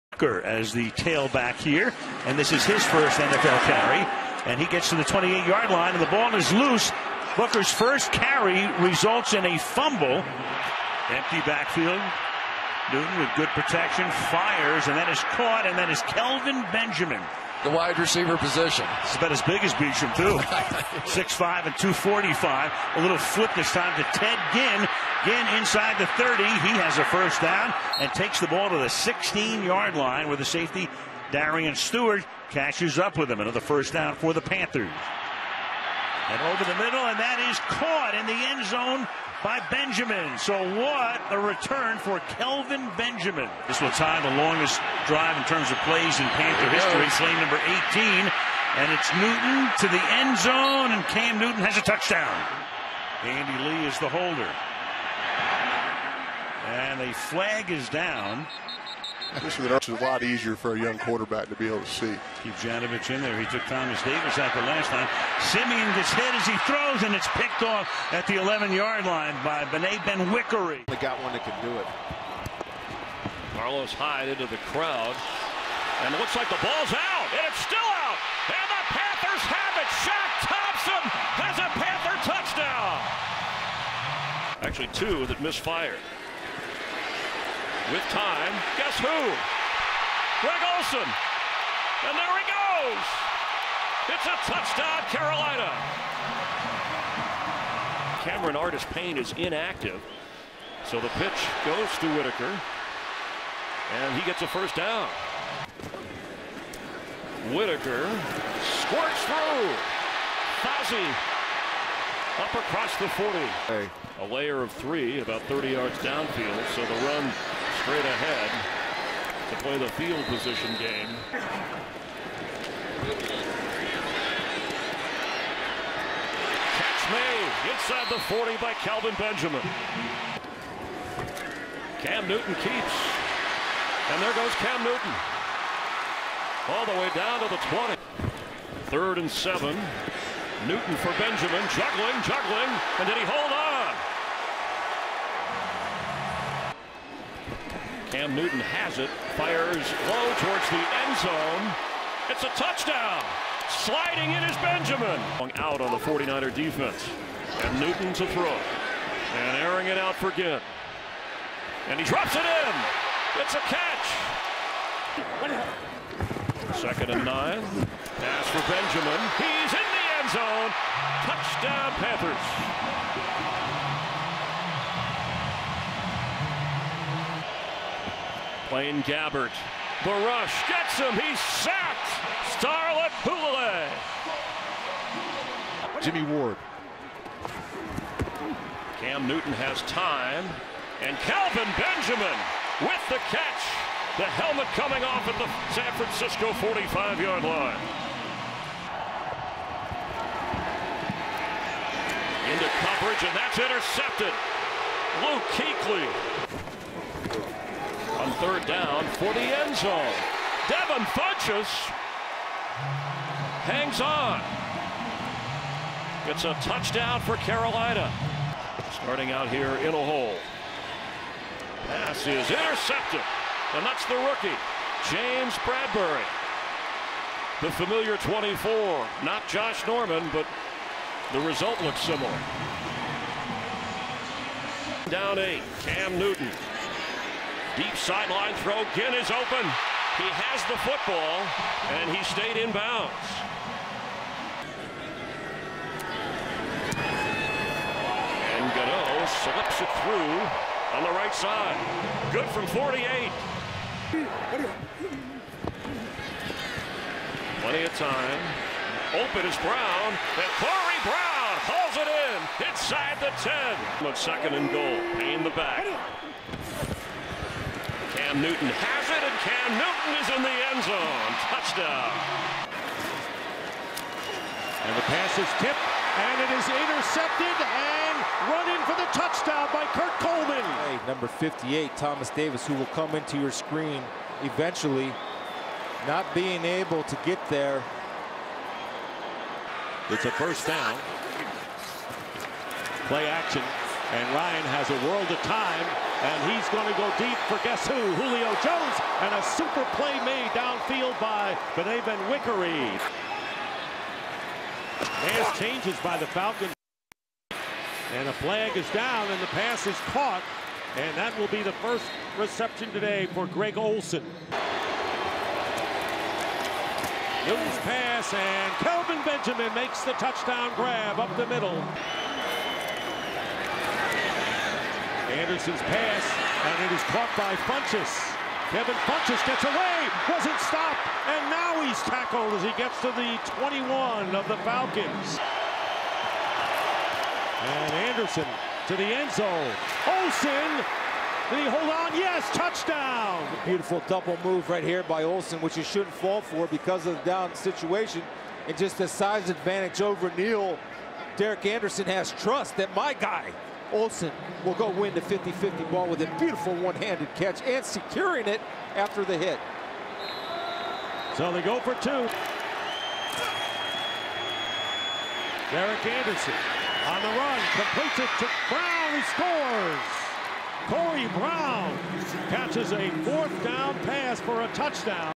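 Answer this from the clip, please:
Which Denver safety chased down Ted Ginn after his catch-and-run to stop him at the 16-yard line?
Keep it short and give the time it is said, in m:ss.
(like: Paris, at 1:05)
Darian Stewart, at 0:31.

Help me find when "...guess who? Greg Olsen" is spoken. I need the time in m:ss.
1:28.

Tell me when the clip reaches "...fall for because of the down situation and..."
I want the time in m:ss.
5:46.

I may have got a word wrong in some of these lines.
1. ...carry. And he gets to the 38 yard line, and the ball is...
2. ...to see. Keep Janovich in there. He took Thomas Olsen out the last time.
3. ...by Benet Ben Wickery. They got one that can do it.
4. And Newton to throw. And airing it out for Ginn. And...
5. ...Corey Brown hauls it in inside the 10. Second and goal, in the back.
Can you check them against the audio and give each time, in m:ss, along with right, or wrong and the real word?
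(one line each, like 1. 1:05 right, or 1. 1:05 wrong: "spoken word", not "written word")
1. 0:03 wrong: "28", not "38"
2. 1:01 wrong: "Davis", not "Olsen"
3. 1:09 right
4. 2:37 right
5. 4:20 right.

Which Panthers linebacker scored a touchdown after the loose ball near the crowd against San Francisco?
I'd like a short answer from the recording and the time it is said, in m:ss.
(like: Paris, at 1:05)
Shaq Thompson, at 1:20.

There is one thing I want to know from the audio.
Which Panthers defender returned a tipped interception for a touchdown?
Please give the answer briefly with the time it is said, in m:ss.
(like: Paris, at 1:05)
Kurt Coleman, at 4:39.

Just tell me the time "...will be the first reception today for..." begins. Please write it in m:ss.
5:11.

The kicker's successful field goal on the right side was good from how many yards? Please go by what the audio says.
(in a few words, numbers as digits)
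48.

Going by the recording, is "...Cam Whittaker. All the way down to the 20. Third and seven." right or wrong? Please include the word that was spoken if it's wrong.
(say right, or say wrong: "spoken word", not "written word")
wrong: "Newton", not "Whittaker".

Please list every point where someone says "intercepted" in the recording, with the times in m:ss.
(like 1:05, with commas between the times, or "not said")
3:23, 3:42, 4:36.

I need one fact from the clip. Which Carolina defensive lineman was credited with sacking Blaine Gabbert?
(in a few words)
Star Lotulelei.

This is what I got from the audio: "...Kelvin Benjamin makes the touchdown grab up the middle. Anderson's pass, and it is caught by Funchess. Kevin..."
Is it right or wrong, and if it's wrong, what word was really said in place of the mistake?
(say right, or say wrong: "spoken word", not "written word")
right.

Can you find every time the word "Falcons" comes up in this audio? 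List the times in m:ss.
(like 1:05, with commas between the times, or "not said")
5:06, 5:34.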